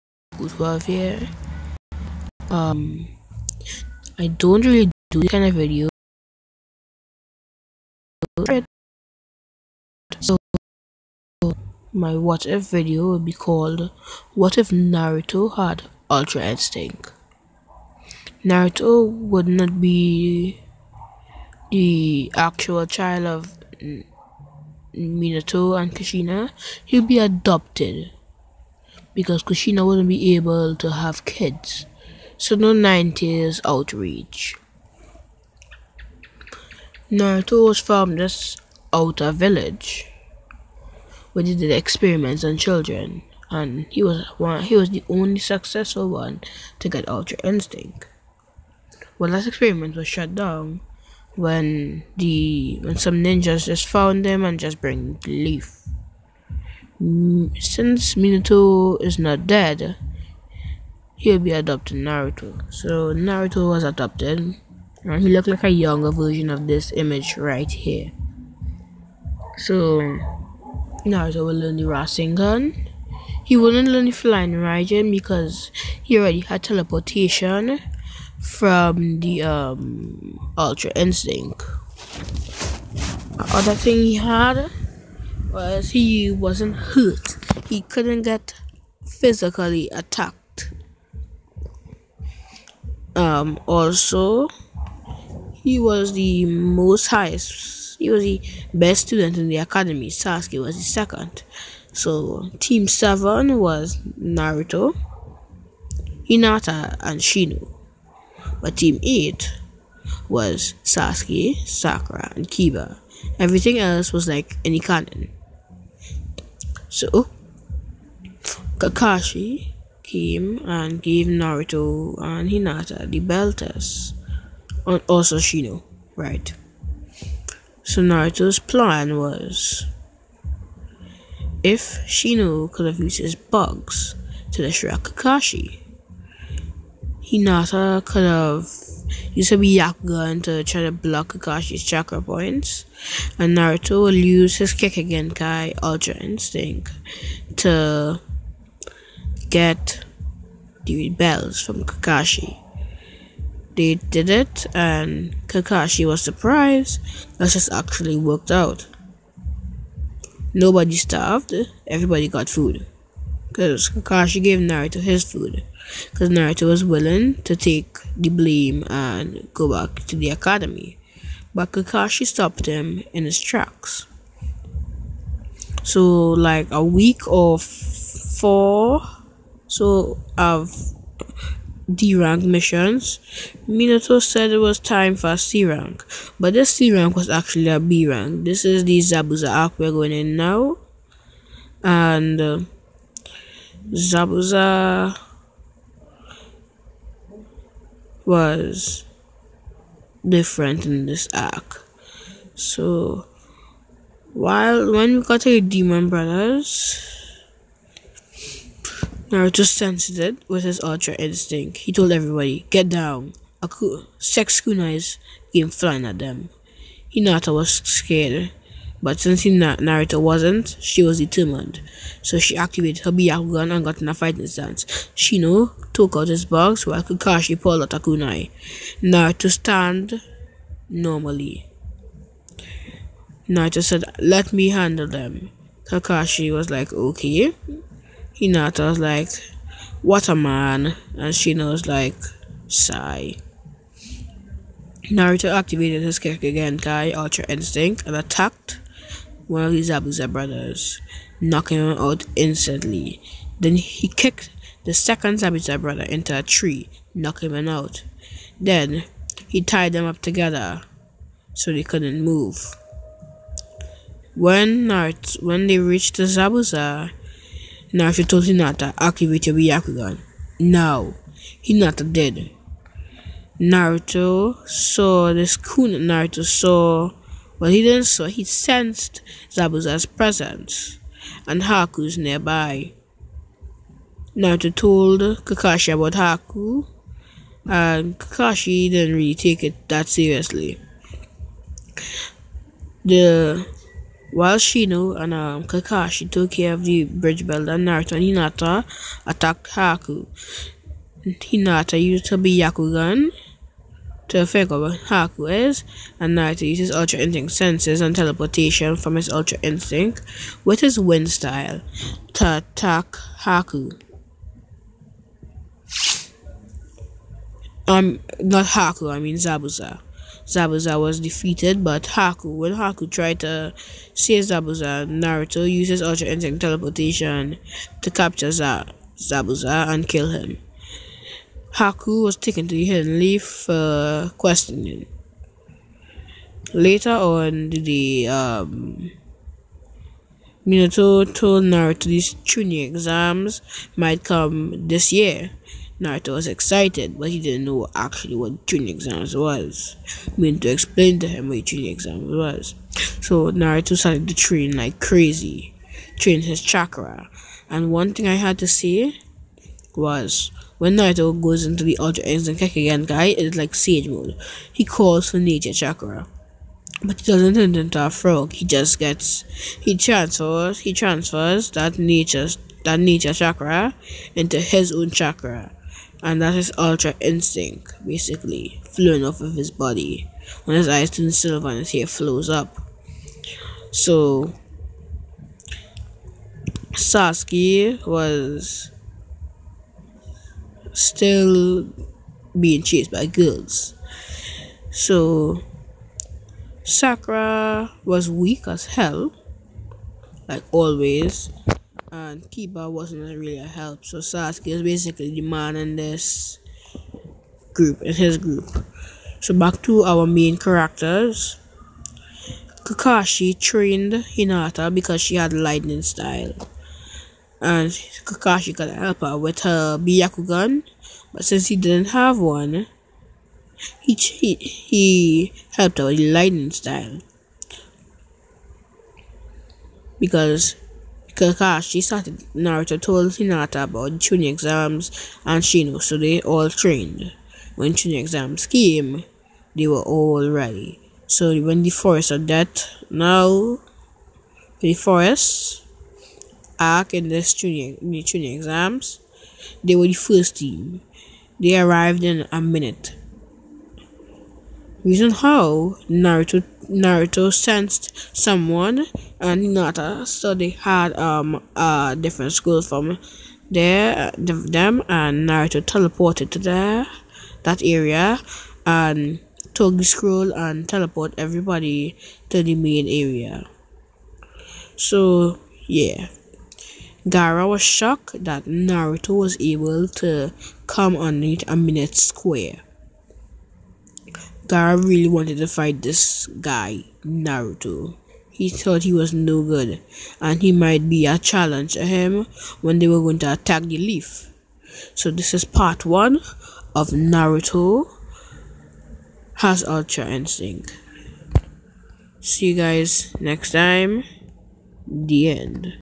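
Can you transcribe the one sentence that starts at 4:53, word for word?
The while Shino and um, Kakashi took care of the bridge builder, and Naruto and Hinata attacked Haku.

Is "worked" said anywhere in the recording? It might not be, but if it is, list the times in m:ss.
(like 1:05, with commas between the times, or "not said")
2:38.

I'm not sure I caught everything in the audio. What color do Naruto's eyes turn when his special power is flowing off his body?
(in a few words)
Silver.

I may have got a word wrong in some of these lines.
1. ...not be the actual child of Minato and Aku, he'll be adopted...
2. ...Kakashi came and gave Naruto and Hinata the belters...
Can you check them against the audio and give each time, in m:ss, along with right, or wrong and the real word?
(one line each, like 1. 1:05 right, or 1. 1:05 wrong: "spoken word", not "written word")
1. 0:19 wrong: "Kushina", not "Aku"
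2. 1:58 right.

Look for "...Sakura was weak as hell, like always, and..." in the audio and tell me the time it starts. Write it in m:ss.
6:36.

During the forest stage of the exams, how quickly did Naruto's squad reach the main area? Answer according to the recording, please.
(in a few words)
In a minute.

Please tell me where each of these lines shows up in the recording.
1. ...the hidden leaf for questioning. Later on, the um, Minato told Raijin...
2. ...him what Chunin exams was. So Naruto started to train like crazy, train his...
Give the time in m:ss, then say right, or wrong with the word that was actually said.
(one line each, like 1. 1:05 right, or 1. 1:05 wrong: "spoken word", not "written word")
1. 5:32 wrong: "Naruto", not "Raijin"
2. 5:51 right.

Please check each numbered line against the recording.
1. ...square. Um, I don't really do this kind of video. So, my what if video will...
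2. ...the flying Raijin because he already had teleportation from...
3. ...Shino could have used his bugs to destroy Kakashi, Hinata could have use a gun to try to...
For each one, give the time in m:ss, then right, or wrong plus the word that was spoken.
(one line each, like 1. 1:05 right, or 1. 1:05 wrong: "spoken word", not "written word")
1. 0:00 wrong: "welfare", not "square"
2. 1:14 right
3. 2:12 right.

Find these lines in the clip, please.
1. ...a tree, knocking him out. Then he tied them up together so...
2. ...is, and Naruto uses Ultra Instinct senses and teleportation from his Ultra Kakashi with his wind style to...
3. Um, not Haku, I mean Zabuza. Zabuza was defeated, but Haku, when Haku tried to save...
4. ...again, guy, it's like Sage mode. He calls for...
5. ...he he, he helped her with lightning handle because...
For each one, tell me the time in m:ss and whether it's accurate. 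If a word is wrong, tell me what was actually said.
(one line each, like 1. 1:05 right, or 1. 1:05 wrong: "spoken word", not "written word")
1. 4:16 right
2. 5:05 wrong: "Instinct", not "Kakashi"
3. 5:17 right
4. 6:02 right
5. 7:04 wrong: "style", not "handle".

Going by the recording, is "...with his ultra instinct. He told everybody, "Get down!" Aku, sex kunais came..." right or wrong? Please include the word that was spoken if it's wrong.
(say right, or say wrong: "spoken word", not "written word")
right.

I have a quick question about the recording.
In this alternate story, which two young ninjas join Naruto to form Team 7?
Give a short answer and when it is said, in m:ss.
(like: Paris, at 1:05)
Hinata and Shino, at 1:44.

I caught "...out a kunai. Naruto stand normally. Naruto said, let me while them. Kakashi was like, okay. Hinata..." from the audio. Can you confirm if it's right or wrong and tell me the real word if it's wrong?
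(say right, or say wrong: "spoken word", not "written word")
wrong: "handle", not "while".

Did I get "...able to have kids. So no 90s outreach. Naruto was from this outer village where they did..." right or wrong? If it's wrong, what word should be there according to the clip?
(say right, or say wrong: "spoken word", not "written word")
right.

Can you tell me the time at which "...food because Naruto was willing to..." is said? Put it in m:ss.
2:45.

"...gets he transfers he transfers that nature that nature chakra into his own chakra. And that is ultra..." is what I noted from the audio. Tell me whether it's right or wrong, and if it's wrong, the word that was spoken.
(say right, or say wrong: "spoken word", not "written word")
right.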